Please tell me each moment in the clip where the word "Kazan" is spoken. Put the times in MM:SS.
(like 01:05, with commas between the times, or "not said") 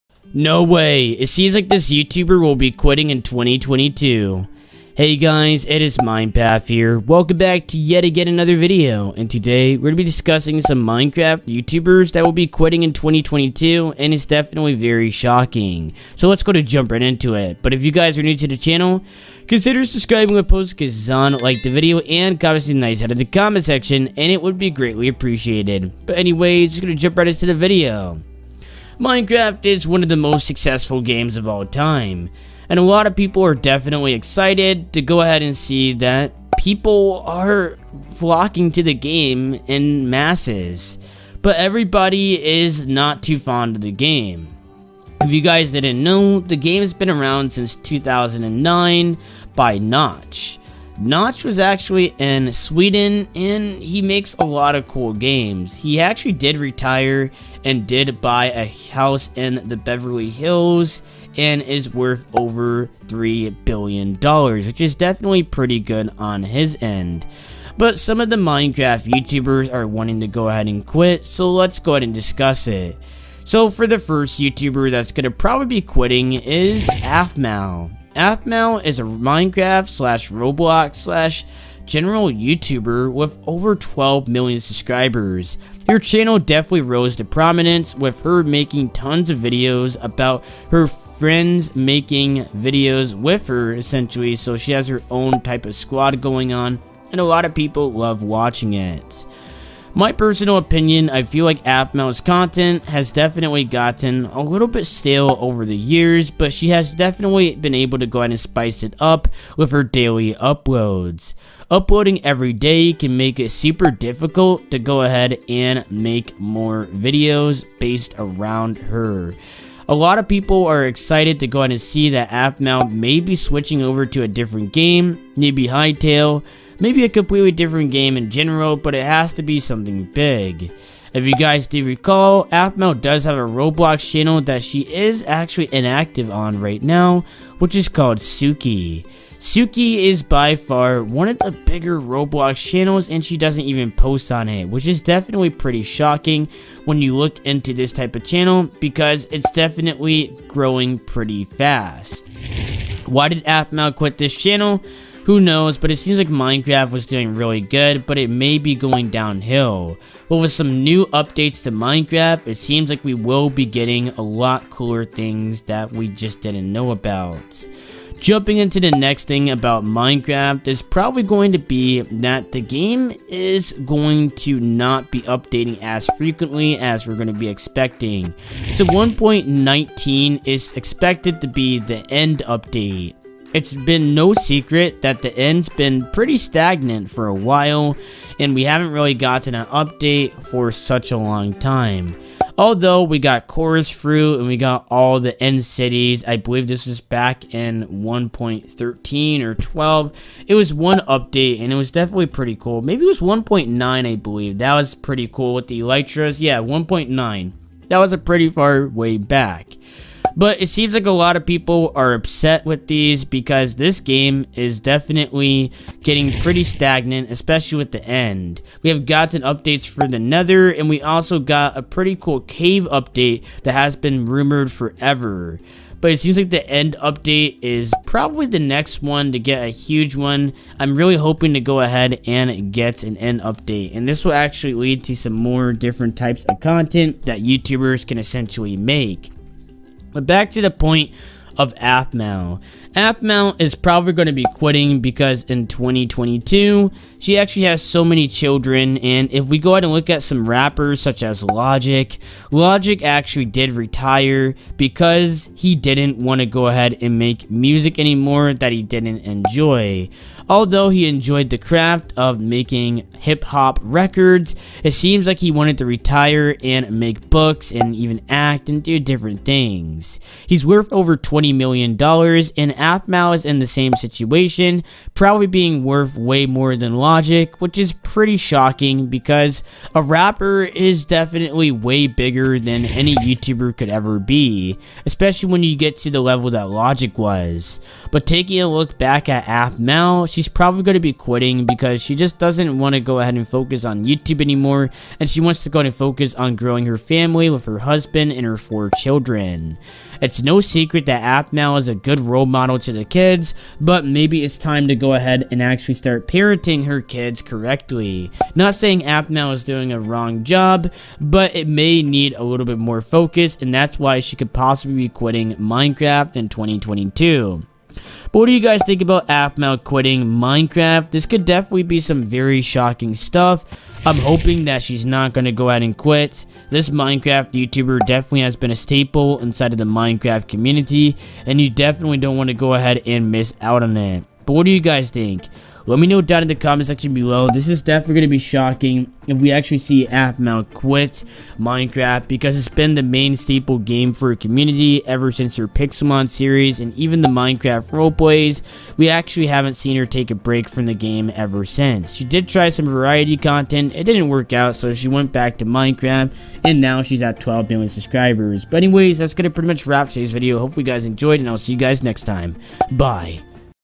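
00:20.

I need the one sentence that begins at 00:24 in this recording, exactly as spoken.
And it would be greatly appreciated.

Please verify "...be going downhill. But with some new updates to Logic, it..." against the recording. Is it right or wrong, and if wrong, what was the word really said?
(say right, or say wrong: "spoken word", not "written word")
wrong: "Minecraft", not "Logic".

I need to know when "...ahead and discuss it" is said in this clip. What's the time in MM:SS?
01:11.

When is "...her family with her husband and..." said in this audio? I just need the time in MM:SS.
04:56.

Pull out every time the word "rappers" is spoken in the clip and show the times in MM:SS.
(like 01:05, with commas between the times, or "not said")
04:10, 04:40.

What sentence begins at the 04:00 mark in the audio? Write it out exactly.
But back to the point of Aphmau.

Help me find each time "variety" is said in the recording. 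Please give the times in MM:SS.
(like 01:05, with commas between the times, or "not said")
05:52.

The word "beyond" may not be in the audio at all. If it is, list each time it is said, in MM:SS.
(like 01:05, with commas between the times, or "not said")
not said.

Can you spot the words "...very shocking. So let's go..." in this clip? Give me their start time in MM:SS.
00:14.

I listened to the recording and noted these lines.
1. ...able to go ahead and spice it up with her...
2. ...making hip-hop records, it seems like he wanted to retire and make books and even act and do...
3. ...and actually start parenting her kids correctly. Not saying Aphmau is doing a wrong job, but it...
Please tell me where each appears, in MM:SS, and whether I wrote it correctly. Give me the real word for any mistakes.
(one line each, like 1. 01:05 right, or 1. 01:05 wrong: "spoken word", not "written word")
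1. 01:47 right
2. 04:22 right
3. 05:05 right.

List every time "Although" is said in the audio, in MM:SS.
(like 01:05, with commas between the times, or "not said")
03:12, 04:20.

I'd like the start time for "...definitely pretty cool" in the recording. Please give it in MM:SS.
03:21.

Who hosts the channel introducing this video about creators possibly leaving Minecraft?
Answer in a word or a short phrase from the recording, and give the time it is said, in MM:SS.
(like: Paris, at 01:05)
MinePath, at 00:05.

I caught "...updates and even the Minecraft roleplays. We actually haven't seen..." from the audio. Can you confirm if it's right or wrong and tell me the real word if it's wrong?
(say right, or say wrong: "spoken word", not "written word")
wrong: "series", not "updates".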